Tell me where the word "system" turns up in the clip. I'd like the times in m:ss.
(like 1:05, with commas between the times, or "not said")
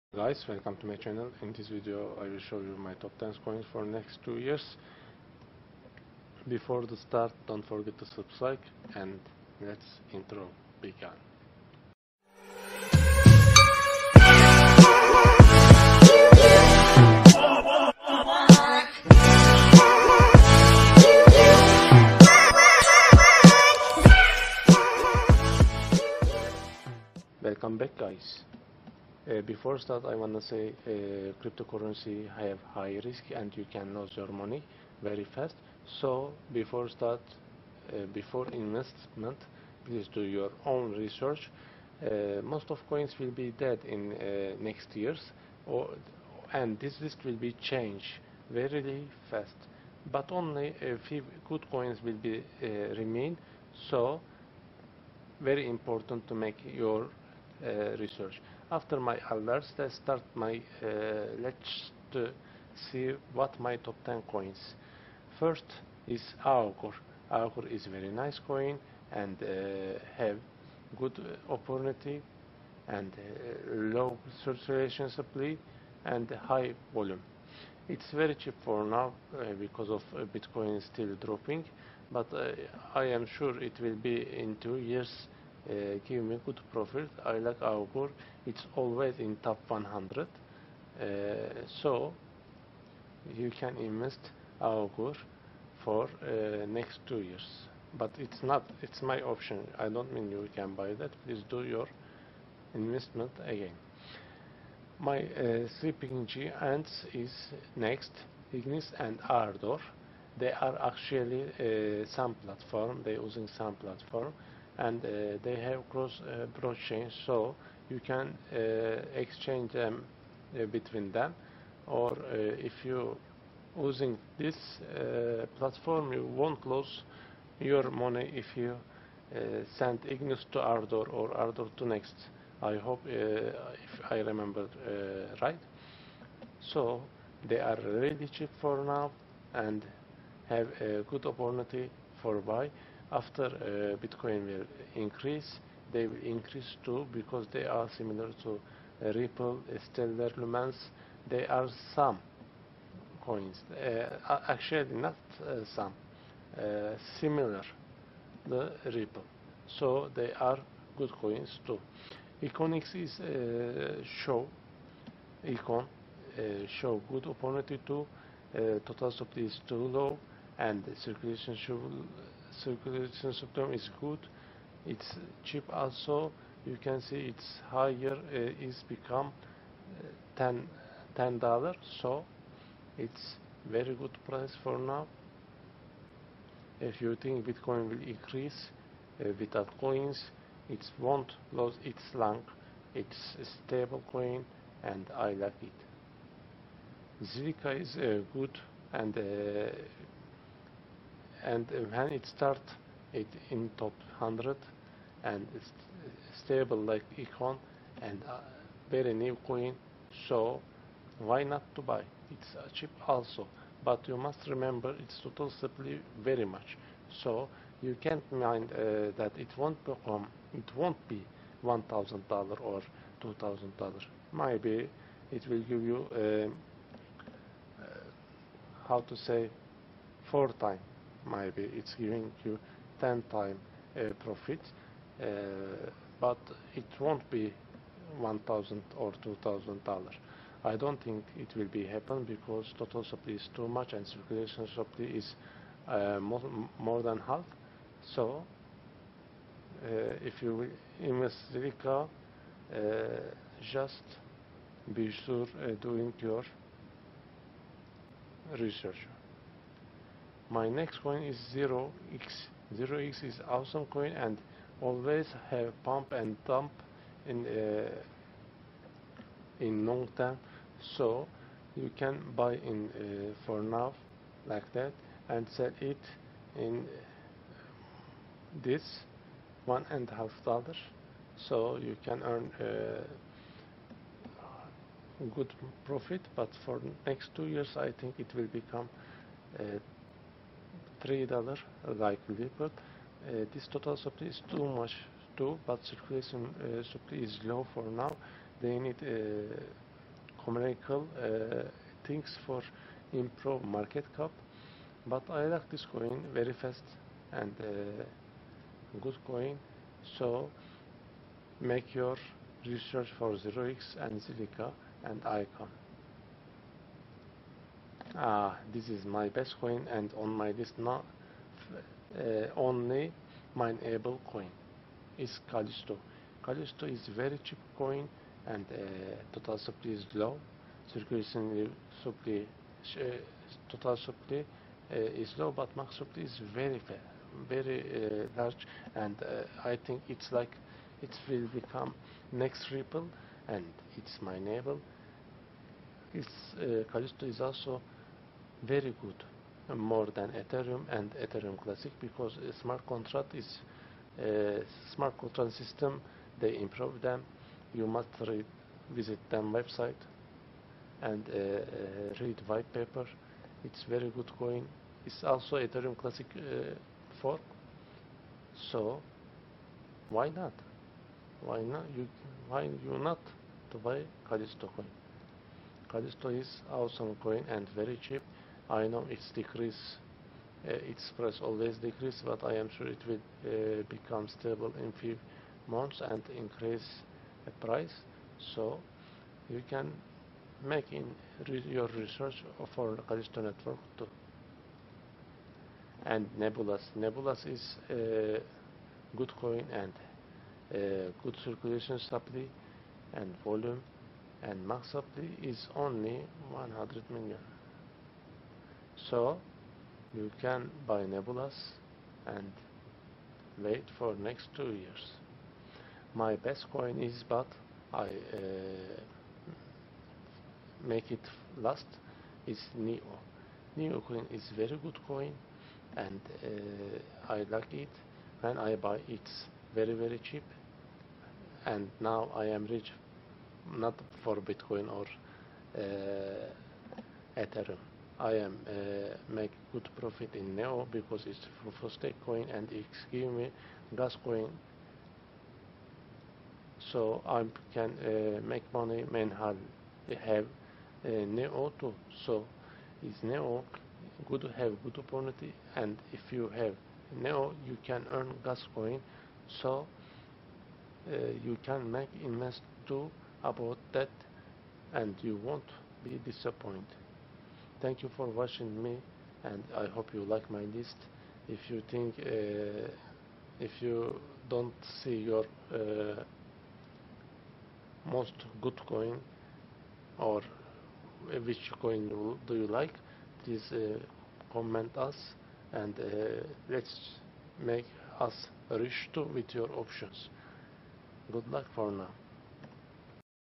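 2:53, 5:55.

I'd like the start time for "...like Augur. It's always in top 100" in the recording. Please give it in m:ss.
1:27.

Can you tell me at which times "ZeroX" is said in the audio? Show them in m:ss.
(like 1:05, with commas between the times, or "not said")
5:13.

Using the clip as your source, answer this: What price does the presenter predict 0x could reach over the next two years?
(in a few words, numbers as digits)
$3.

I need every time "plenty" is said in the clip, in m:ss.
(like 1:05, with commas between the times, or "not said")
not said.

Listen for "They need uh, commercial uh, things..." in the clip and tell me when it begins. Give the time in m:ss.
4:58.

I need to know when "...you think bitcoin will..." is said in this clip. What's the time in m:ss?
3:07.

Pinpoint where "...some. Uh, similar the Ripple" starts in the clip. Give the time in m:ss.
2:35.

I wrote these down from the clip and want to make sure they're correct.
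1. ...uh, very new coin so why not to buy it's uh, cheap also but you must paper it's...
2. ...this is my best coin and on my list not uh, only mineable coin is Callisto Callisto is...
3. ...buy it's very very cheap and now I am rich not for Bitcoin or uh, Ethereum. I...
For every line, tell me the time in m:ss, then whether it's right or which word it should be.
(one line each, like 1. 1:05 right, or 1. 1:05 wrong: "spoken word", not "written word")
1. 3:28 wrong: "remember", not "paper"
2. 5:18 right
3. 7:08 right.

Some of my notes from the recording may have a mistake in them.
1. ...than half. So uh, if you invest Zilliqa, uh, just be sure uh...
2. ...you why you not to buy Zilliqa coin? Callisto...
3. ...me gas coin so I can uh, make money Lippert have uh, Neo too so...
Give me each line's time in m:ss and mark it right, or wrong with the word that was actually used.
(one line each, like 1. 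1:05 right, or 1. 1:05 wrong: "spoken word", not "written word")
1. 4:07 right
2. 6:11 wrong: "Callisto", not "Zilliqa"
3. 7:23 wrong: "Manhattan", not "Lippert".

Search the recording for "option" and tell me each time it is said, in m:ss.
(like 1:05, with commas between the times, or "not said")
1:39, 8:09.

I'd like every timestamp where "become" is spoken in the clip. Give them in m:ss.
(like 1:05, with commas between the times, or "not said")
2:58, 3:39, 4:48, 5:41, 6:23.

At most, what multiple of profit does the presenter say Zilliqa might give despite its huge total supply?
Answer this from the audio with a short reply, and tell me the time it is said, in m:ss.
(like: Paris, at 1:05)
10 times, at 3:52.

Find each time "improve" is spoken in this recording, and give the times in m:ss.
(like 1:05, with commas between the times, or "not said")
5:03, 5:56.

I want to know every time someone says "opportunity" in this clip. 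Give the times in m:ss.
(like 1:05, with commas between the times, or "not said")
1:11, 2:21, 2:47, 7:34.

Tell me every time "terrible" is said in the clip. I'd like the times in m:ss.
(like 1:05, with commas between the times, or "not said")
not said.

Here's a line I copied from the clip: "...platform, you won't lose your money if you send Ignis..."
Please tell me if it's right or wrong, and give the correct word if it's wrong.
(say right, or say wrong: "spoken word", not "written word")
right.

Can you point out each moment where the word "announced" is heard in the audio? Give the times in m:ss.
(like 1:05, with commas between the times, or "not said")
not said.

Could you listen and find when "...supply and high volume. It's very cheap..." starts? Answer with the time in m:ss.
1:15.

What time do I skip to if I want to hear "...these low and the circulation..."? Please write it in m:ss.
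2:49.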